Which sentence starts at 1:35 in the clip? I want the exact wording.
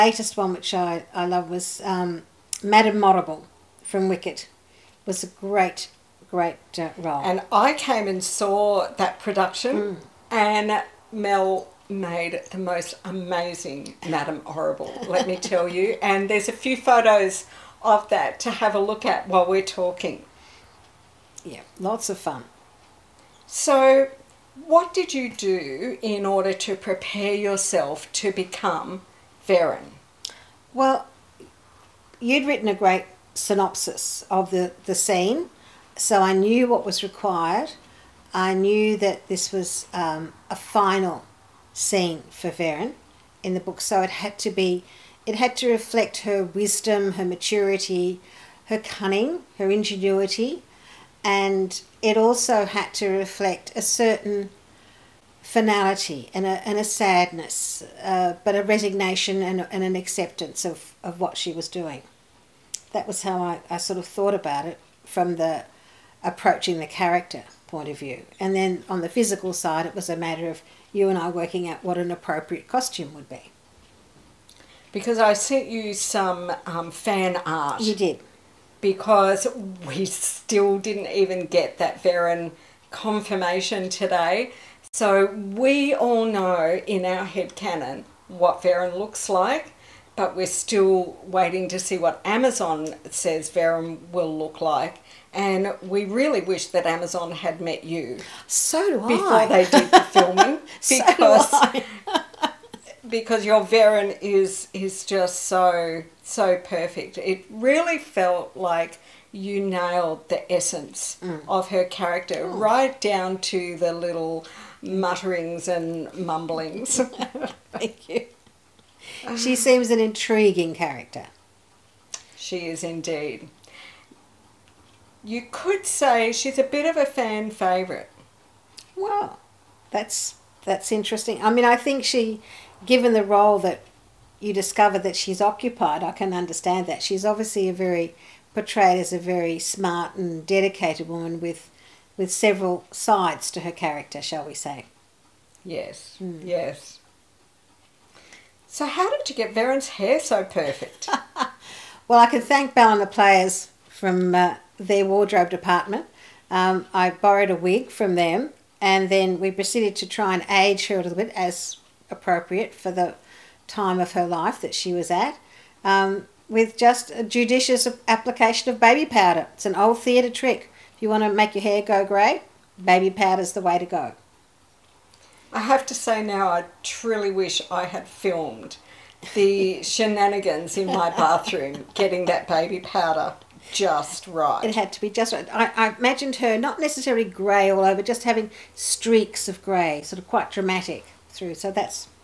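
And we really wish that Amazon had met you.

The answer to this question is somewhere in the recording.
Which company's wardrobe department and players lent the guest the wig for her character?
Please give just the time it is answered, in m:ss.
2:32.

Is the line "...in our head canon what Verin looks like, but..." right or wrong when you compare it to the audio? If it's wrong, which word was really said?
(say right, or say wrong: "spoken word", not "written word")
right.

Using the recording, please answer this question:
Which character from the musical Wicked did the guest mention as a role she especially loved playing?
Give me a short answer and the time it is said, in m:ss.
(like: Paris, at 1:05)
Madame Morrible, at 0:02.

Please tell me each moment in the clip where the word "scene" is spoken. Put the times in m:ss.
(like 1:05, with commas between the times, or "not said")
0:34, 0:41.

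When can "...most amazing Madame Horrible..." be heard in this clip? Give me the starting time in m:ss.
0:12.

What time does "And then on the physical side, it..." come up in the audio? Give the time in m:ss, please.
1:08.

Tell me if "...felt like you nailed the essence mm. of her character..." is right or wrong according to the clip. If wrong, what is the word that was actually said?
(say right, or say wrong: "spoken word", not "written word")
right.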